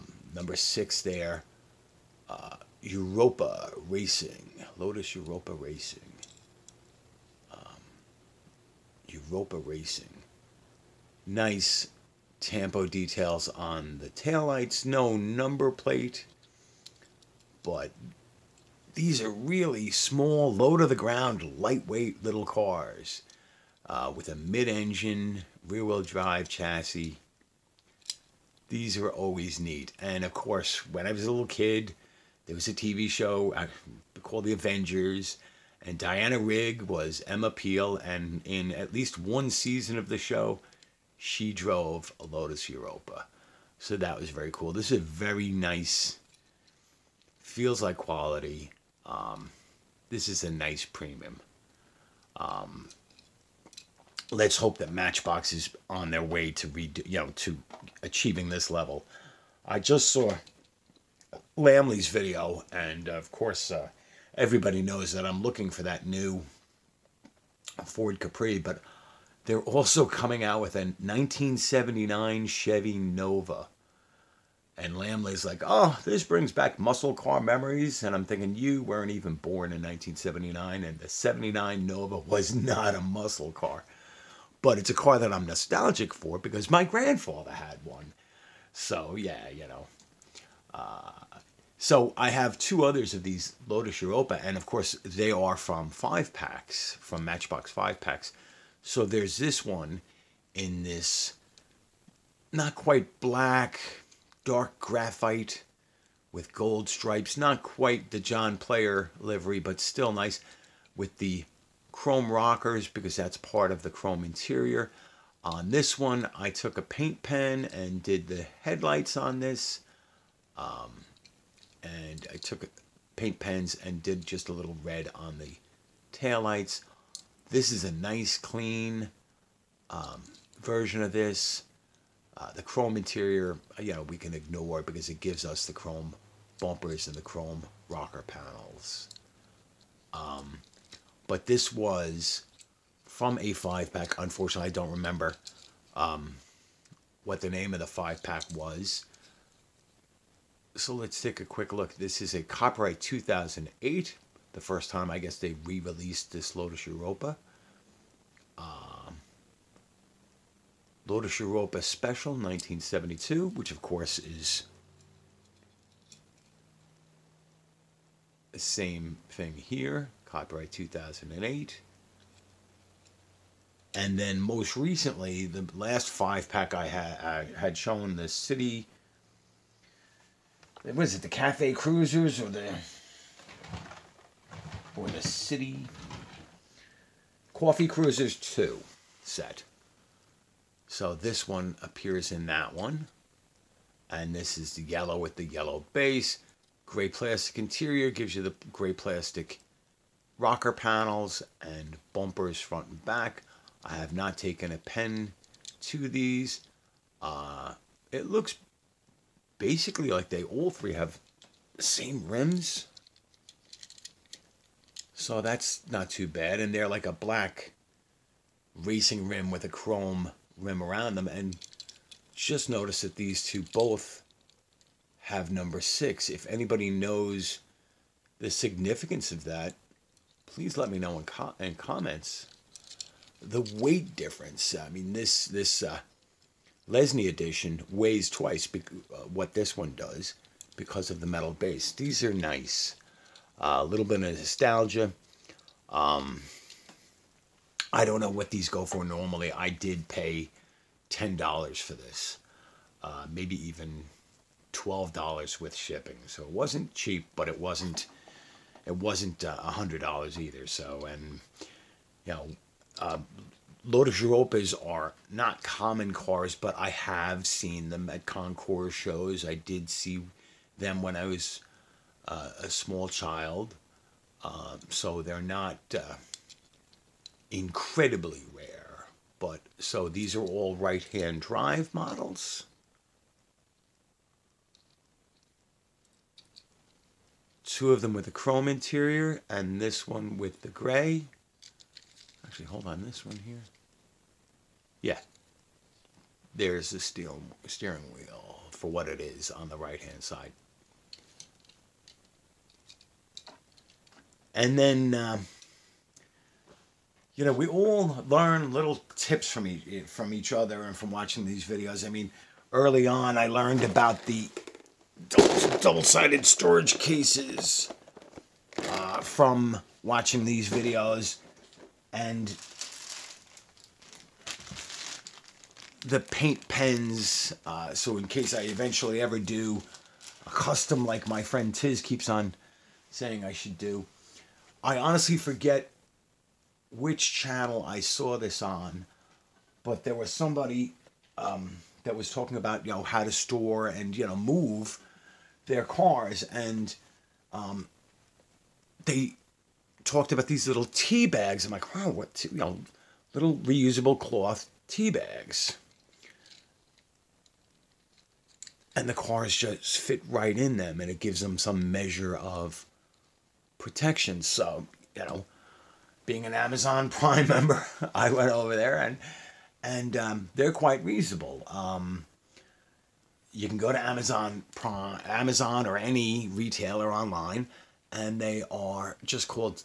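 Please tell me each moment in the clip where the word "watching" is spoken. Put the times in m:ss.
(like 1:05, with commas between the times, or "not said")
5:11, 5:20.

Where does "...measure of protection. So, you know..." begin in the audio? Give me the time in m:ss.
6:01.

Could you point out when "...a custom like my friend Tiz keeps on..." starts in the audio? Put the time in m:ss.
5:30.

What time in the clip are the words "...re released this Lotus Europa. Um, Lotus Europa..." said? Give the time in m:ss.
2:35.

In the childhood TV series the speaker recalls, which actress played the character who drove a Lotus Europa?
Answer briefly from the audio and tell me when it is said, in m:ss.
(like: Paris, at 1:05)
Diana Rigg, at 0:35.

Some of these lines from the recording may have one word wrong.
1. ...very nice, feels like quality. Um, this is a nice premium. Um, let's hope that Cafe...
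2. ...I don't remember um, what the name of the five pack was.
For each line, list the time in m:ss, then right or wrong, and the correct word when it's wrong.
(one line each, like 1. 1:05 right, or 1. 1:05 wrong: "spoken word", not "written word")
1. 0:45 wrong: "Matchbox", not "Cafe"
2. 2:24 right.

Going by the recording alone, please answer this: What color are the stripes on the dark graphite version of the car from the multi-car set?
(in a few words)
gold.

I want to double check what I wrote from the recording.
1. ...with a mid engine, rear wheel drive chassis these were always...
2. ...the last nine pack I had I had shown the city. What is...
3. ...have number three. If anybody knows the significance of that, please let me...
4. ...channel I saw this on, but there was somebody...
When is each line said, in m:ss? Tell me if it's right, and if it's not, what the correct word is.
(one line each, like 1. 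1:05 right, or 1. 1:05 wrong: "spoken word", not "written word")
1. 0:24 right
2. 2:55 wrong: "five", not "nine"
3. 3:45 wrong: "six", not "three"
4. 5:37 right.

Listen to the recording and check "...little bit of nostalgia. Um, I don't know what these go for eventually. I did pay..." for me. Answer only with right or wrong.
wrong.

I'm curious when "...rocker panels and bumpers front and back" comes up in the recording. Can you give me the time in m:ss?
3:20.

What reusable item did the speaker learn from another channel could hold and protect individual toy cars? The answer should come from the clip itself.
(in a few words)
cloth tea bags.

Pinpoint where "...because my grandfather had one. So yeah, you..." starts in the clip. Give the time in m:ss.
1:26.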